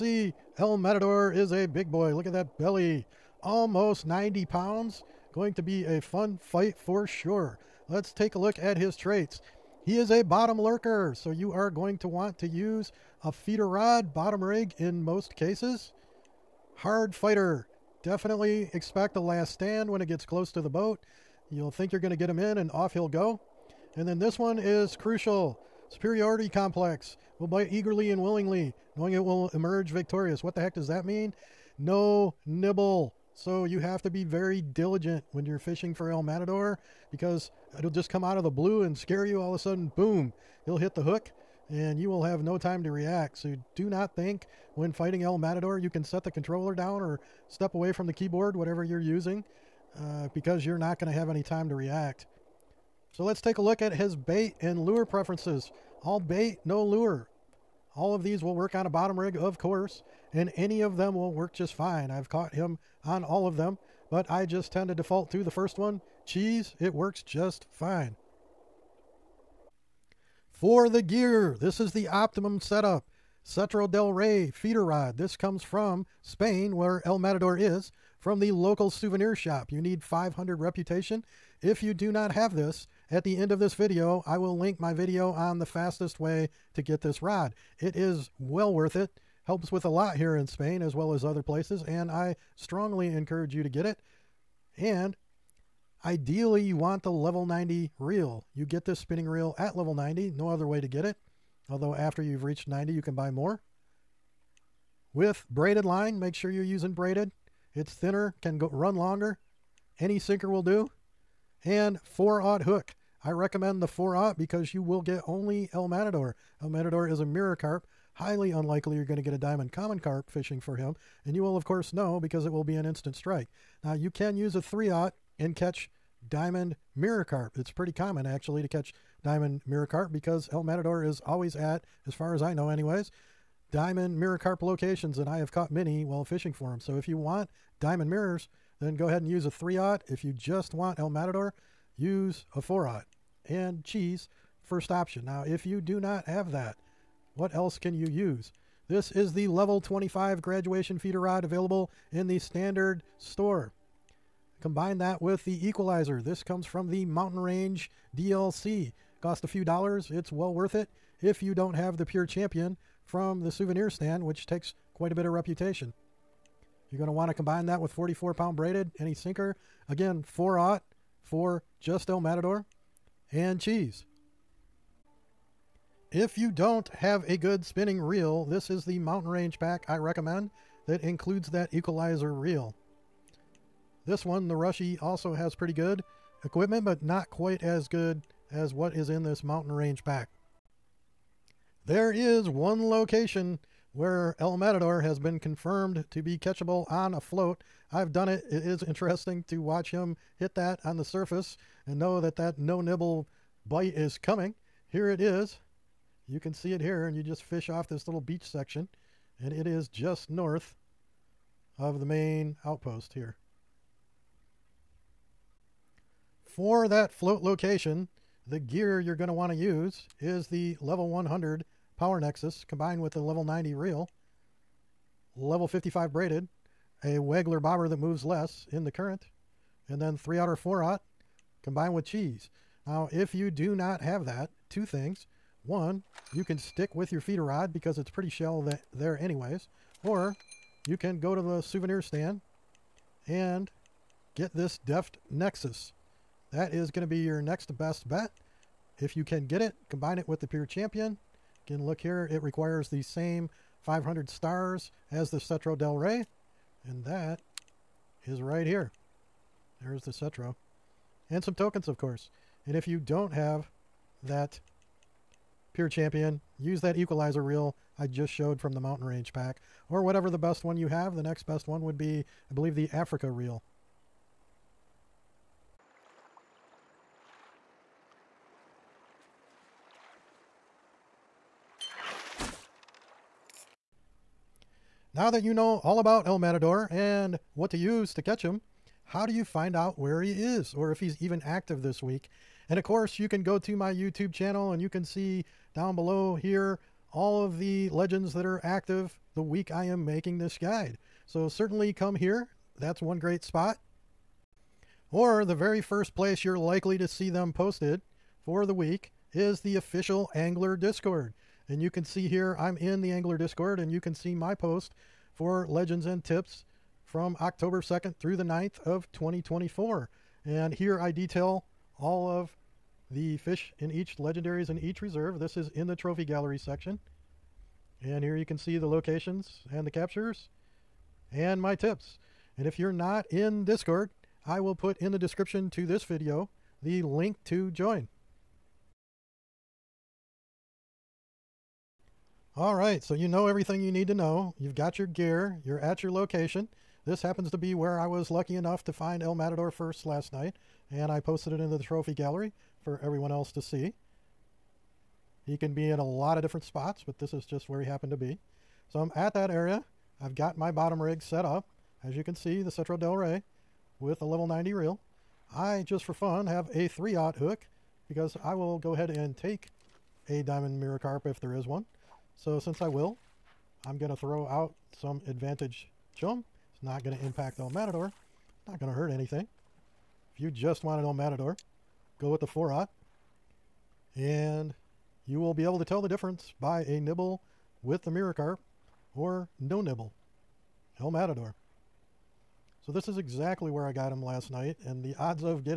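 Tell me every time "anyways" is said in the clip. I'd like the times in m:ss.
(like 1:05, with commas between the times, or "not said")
2:12, 3:59.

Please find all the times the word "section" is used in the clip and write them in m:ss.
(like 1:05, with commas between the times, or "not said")
3:28, 5:26.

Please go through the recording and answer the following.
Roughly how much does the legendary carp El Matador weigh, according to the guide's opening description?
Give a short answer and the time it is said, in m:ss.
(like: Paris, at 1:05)
Almost 90 pounds, at 0:03.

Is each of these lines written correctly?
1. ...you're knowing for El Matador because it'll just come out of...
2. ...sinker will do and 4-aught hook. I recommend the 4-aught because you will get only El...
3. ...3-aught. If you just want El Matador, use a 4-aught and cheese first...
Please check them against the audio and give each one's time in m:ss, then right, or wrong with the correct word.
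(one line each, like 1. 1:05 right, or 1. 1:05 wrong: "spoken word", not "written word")
1. 0:35 wrong: "fishing", not "knowing"
2. 1:50 right
3. 2:19 right.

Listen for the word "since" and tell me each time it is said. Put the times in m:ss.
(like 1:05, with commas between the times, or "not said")
6:12.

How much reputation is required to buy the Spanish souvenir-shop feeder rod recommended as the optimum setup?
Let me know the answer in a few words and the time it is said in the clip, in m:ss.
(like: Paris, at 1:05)
500, at 1:20.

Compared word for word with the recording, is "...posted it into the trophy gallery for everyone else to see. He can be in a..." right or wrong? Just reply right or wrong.
right.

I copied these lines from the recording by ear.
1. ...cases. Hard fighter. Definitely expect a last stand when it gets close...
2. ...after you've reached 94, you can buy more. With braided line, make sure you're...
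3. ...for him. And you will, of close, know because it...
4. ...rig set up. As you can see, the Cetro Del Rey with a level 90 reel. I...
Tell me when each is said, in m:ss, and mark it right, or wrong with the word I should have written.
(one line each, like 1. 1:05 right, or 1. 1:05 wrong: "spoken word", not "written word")
1. 0:15 right
2. 1:41 wrong: "90", not "94"
3. 2:00 wrong: "course", not "close"
4. 6:01 right.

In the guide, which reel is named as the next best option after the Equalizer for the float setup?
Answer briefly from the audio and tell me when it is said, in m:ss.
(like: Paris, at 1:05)
Africa reel, at 4:32.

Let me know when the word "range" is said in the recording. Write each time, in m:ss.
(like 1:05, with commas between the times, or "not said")
2:37, 2:59, 3:09, 4:29.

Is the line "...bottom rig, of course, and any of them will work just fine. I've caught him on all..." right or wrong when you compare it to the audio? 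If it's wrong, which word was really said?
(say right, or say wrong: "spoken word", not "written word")
right.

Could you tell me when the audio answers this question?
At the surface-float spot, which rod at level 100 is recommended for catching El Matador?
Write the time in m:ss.
3:41.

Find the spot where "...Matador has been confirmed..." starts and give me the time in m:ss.
3:14.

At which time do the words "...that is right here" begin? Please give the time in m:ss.
4:17.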